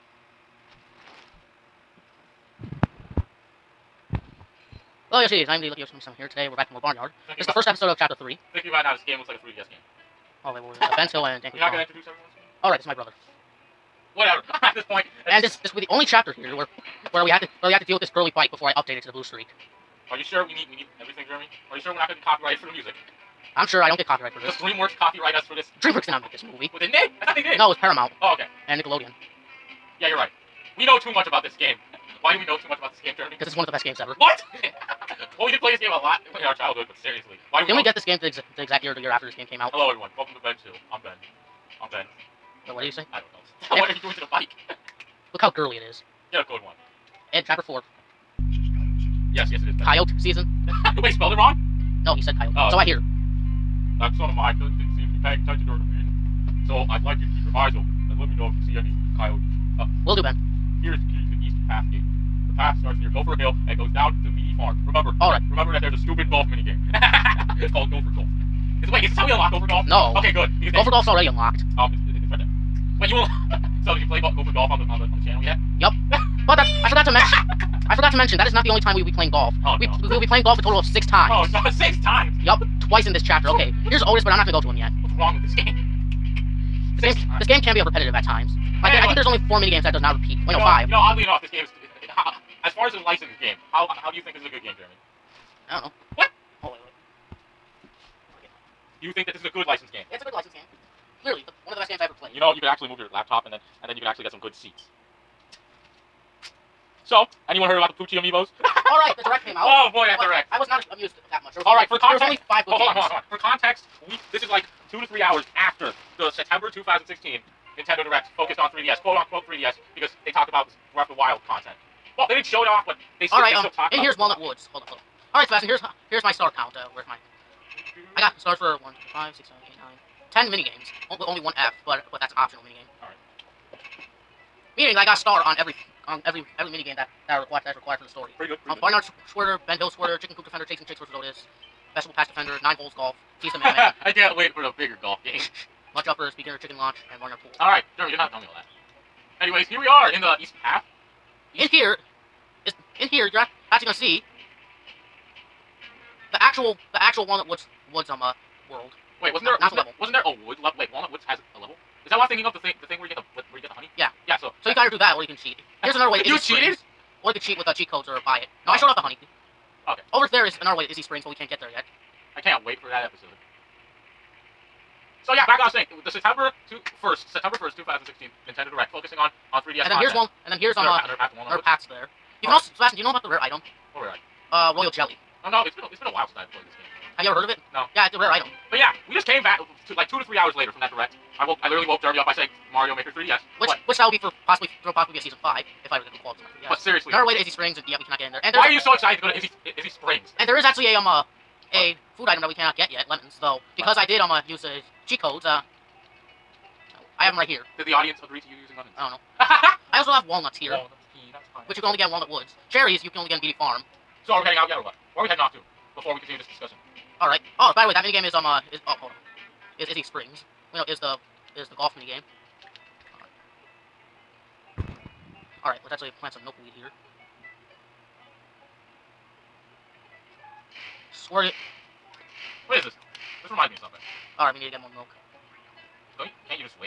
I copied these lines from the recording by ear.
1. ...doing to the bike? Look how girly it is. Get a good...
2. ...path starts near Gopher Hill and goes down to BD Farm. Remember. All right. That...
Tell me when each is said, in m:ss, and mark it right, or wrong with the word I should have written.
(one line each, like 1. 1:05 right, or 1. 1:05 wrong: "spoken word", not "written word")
1. 0:44 right
2. 1:02 right.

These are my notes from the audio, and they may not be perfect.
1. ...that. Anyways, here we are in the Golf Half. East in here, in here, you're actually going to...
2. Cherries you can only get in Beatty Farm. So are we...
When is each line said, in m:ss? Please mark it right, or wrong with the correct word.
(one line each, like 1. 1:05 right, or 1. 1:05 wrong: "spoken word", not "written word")
1. 2:28 wrong: "East", not "Golf"
2. 3:32 right.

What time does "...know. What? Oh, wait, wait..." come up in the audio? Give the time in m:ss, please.
1:35.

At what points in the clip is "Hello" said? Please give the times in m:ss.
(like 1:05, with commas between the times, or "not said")
0:05, 0:39.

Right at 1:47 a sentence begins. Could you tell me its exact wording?
So, Anyone heard about the Poochy Amiibos?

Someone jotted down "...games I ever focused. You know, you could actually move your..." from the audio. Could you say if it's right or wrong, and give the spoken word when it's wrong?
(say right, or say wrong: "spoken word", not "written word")
wrong: "played", not "focused".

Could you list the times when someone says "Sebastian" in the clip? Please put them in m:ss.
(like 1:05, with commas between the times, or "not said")
2:05, 3:02.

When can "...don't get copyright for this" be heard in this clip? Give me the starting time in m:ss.
0:23.